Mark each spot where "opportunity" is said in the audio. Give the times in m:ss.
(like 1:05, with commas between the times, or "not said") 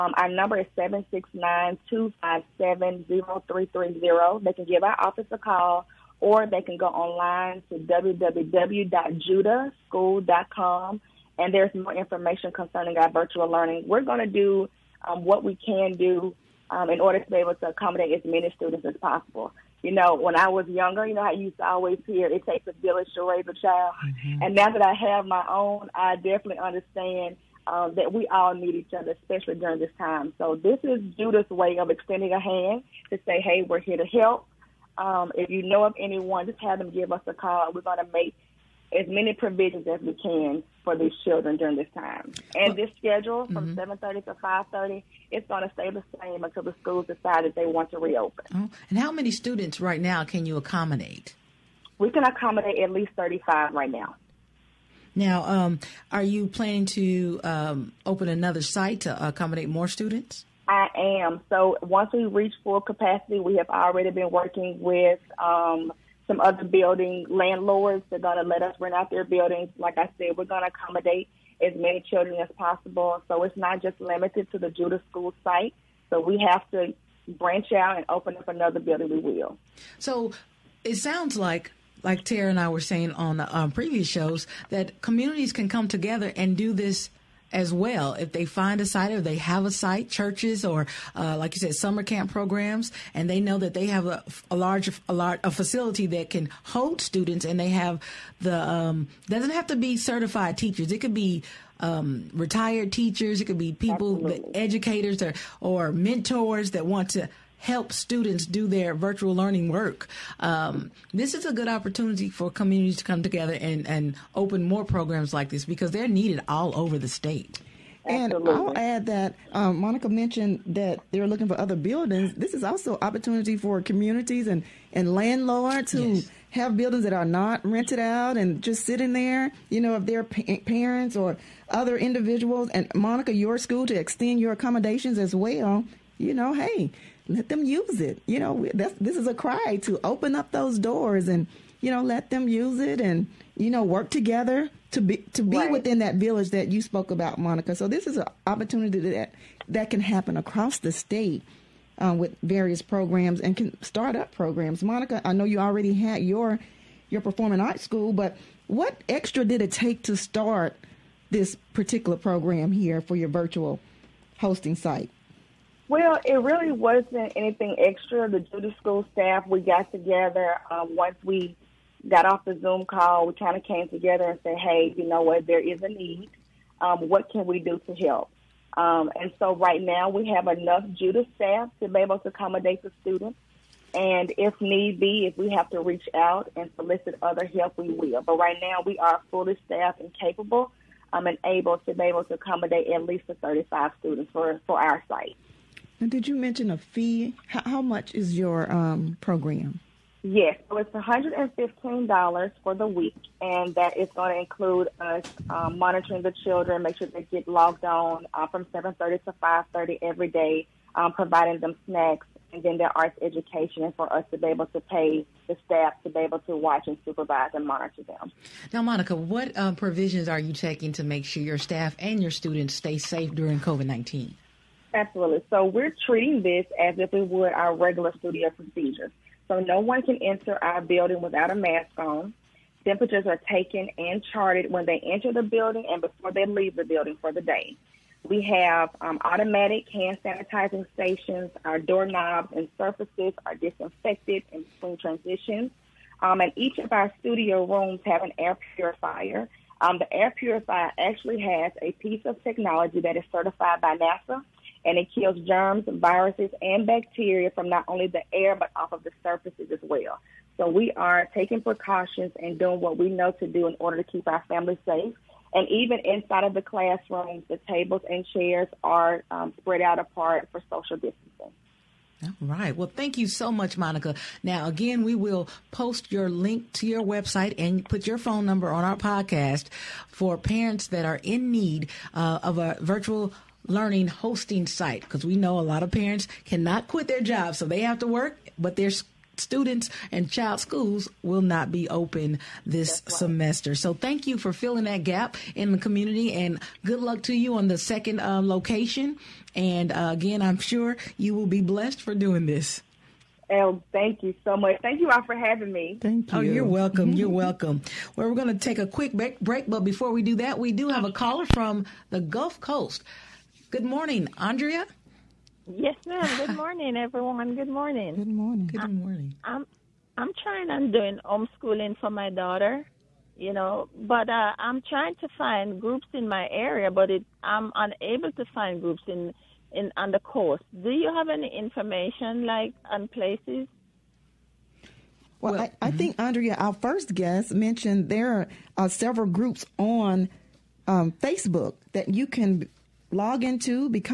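1:51, 2:03, 2:28.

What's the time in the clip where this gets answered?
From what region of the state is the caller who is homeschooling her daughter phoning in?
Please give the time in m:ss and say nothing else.
5:12.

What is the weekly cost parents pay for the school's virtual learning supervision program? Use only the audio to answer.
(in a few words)
$115.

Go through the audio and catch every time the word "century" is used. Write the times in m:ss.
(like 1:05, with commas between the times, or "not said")
not said.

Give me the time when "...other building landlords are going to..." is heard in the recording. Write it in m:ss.
1:06.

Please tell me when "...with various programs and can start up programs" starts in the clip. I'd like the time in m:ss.
2:32.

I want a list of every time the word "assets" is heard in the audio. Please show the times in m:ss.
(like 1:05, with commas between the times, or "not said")
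not said.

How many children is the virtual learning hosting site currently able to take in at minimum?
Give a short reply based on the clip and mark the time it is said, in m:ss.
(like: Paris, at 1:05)
35, at 0:52.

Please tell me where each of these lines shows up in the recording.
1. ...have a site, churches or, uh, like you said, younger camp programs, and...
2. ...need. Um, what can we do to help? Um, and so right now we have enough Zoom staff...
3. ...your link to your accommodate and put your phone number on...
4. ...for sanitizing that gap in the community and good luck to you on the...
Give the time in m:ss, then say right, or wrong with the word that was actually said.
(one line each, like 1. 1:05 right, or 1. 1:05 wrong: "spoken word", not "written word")
1. 1:29 wrong: "summer", not "younger"
2. 2:55 wrong: "Judah", not "Zoom"
3. 4:36 wrong: "website", not "accommodate"
4. 4:54 wrong: "filling", not "sanitizing".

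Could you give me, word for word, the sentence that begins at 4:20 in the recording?
So we are taking precautions and doing what we know to do in order to keep our families safe.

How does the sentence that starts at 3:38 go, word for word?
Now, Monica, what uh, provisions are you taking to make sure your staff and your students stay safe during COVID-19?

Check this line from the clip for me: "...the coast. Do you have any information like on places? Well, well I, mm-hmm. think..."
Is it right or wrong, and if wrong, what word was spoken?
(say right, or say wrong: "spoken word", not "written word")
right.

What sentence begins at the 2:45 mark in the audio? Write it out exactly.
Well, it really wasn't anything extra.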